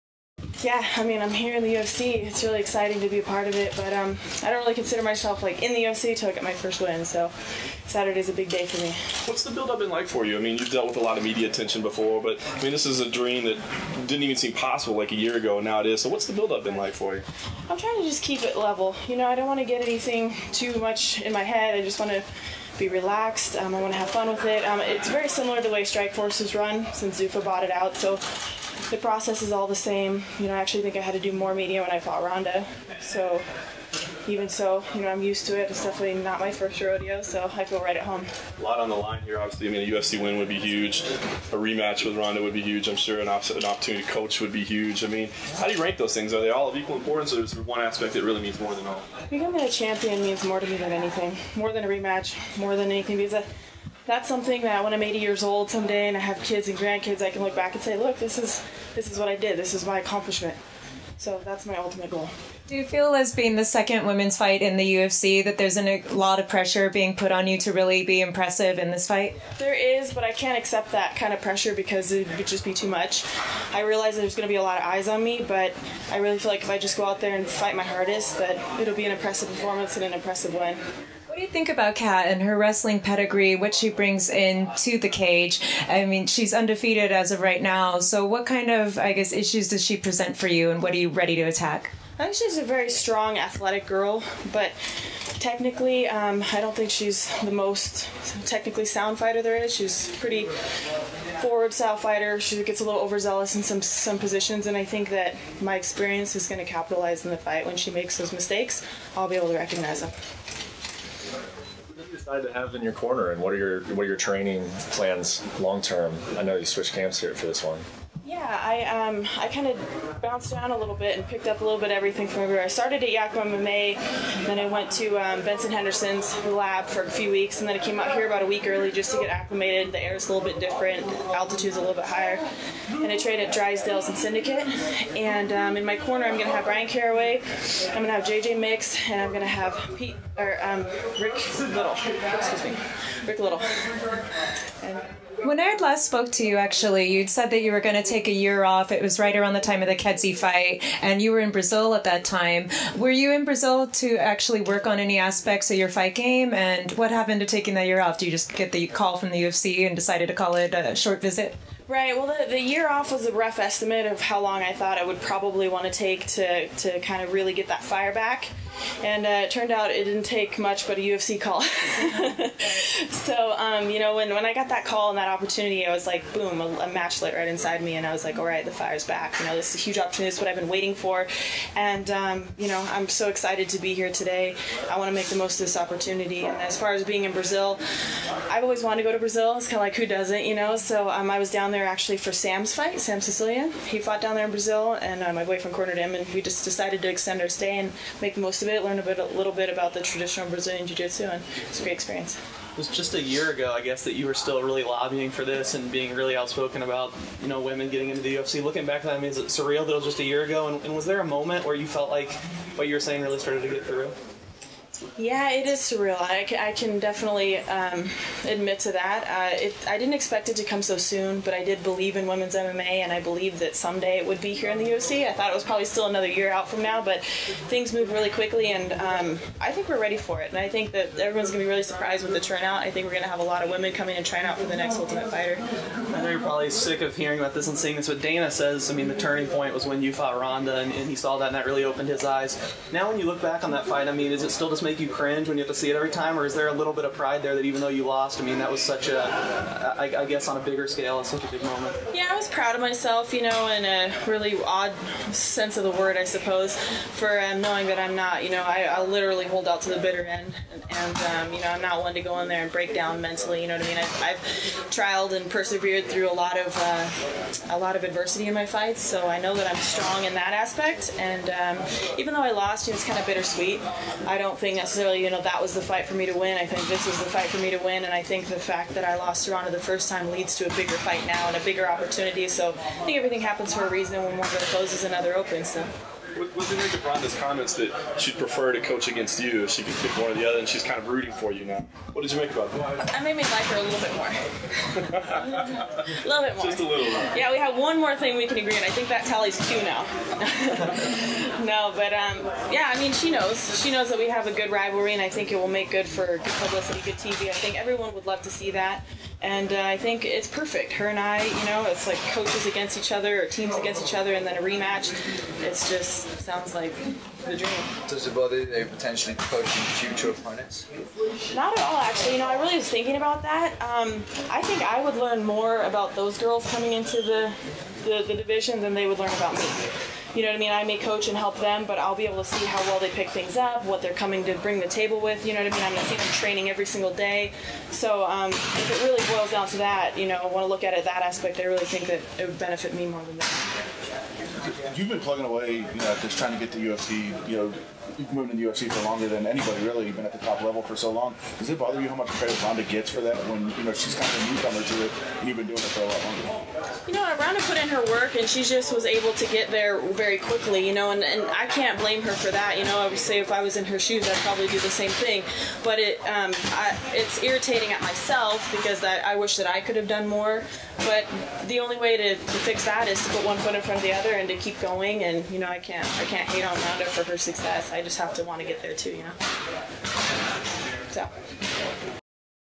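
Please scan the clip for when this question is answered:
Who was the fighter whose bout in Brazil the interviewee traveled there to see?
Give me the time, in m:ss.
3:12.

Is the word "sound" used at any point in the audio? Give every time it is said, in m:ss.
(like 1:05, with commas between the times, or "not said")
1:38, 5:16.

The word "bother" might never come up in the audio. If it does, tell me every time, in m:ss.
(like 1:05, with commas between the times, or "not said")
5:18, 5:51.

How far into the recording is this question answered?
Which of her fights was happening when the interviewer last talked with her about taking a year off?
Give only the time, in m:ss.
2:29.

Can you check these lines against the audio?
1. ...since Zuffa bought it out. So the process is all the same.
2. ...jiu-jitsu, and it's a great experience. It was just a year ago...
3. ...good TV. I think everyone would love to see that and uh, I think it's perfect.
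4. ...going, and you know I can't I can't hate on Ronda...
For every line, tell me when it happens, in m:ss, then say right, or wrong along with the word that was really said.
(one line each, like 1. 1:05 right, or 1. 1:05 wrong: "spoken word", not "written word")
1. 0:26 right
2. 3:20 right
3. 5:07 right
4. 6:14 right.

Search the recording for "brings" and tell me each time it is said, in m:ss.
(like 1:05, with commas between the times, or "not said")
1:23, 5:34.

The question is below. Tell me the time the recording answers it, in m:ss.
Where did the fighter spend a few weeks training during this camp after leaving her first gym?
2:05.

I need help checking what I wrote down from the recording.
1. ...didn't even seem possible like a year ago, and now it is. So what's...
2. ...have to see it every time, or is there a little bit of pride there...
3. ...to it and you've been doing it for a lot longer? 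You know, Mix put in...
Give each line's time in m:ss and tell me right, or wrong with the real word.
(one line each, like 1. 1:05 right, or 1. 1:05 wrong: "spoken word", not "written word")
1. 0:14 right
2. 4:05 right
3. 5:54 wrong: "Ronda", not "Mix".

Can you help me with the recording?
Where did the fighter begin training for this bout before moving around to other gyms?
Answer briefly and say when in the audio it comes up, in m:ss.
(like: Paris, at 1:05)
Yakima MMA, at 2:03.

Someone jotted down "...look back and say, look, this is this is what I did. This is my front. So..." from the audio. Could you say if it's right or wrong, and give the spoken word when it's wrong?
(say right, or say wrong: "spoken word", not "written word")
wrong: "accomplishment", not "front".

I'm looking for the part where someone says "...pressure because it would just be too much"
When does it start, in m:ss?
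1:11.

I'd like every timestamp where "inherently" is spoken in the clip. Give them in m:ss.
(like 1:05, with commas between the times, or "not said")
not said.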